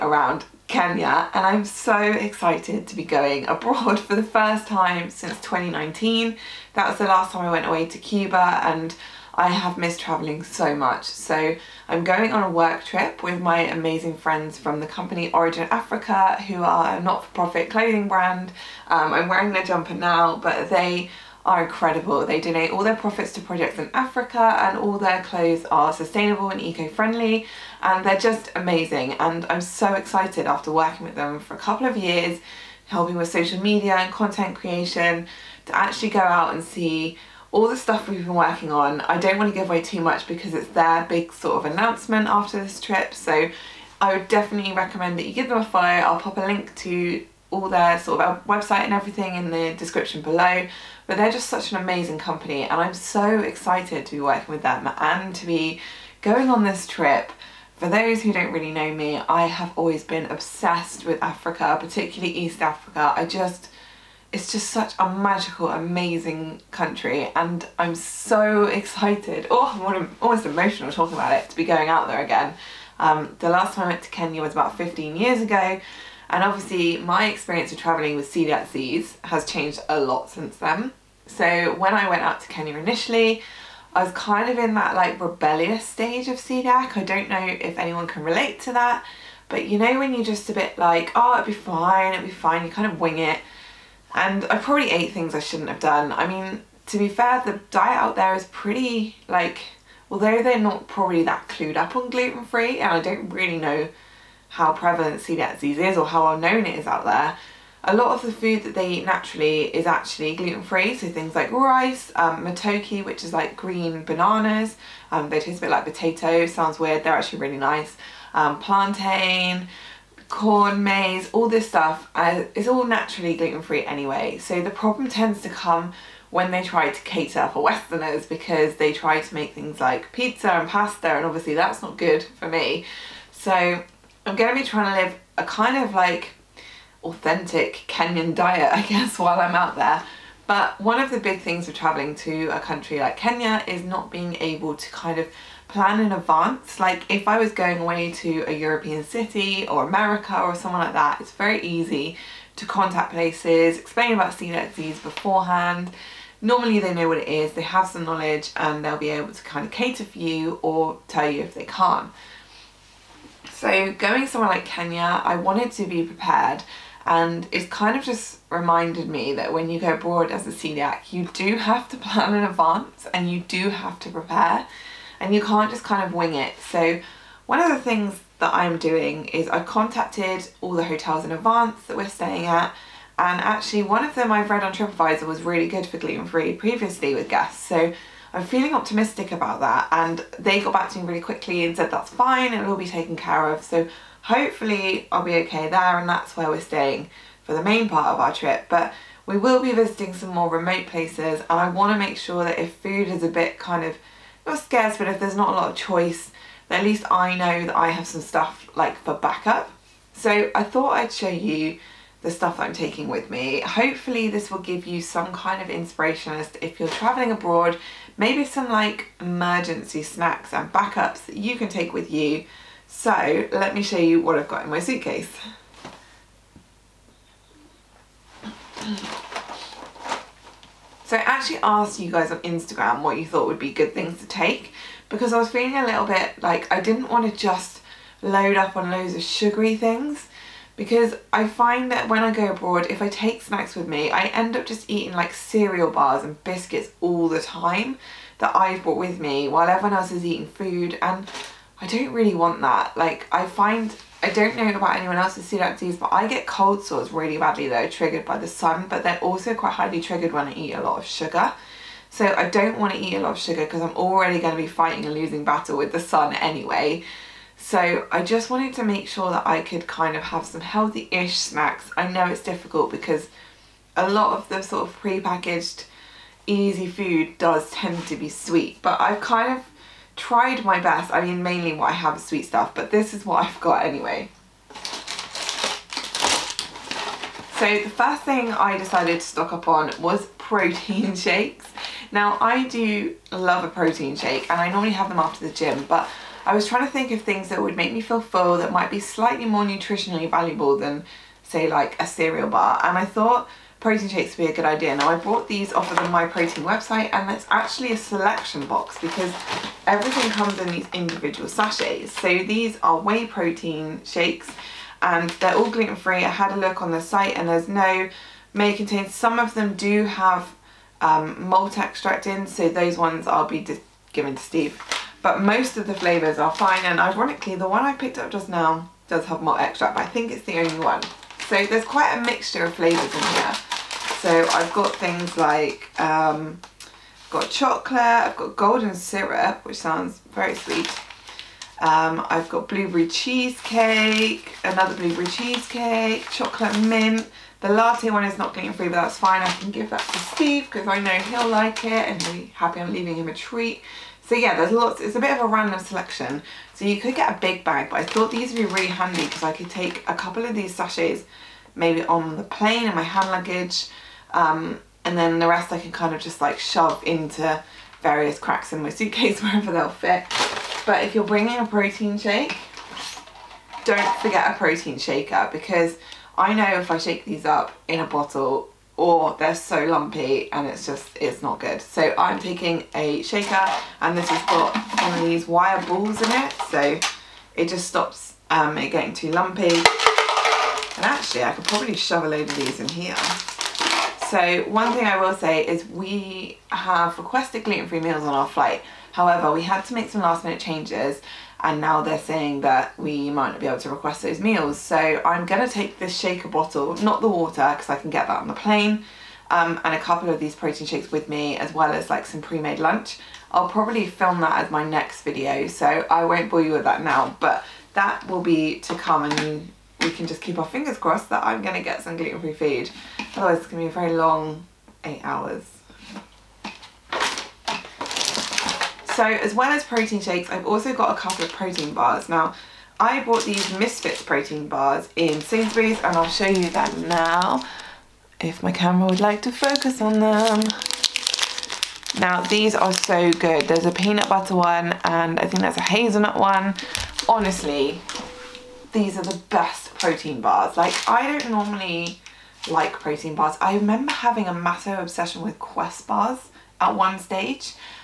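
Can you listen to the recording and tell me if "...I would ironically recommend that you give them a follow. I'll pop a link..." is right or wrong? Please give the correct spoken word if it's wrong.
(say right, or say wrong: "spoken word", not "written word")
wrong: "definitely", not "ironically".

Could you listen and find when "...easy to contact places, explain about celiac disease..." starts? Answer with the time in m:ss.
2:31.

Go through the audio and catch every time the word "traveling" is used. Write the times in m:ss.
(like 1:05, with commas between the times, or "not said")
0:10, 1:17, 2:21, 3:36.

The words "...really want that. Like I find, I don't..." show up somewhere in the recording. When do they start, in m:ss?
4:12.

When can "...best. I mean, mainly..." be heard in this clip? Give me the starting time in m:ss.
4:40.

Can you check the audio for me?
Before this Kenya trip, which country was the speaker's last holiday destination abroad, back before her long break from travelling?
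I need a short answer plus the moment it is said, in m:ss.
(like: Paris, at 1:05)
Cuba, at 0:07.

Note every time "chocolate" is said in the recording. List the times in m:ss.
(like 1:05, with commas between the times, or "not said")
5:37, 5:46.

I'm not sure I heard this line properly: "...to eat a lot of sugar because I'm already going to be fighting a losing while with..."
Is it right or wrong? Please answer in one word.
wrong.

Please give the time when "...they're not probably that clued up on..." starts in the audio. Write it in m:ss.
1:40.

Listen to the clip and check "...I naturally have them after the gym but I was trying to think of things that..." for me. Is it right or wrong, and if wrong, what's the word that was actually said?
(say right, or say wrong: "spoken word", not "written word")
wrong: "normally", not "naturally".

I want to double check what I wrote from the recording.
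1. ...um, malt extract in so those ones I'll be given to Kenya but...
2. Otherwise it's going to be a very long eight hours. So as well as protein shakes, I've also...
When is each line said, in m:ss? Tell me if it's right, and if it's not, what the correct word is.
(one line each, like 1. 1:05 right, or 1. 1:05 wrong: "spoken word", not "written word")
1. 5:21 wrong: "Steve", not "Kenya"
2. 7:03 right.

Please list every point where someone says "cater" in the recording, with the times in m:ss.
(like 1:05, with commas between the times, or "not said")
2:07, 2:39.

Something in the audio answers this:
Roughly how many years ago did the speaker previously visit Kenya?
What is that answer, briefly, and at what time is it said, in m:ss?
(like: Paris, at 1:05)
15, at 1:14.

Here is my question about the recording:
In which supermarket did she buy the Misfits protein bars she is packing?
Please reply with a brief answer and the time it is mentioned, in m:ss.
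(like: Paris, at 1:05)
Sainsbury's, at 7:15.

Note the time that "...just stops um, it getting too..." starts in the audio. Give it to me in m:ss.
6:27.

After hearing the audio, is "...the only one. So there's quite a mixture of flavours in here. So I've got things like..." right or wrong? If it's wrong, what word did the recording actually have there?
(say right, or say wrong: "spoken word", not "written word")
right.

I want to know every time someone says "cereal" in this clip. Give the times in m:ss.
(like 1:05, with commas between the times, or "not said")
4:05, 5:02.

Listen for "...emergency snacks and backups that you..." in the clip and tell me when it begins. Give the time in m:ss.
3:39.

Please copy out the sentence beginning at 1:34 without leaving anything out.
And I probably ate things I shouldn't have done.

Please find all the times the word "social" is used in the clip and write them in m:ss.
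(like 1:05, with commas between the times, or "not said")
0:33.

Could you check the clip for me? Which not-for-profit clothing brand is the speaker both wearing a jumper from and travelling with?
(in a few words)
Origin Africa.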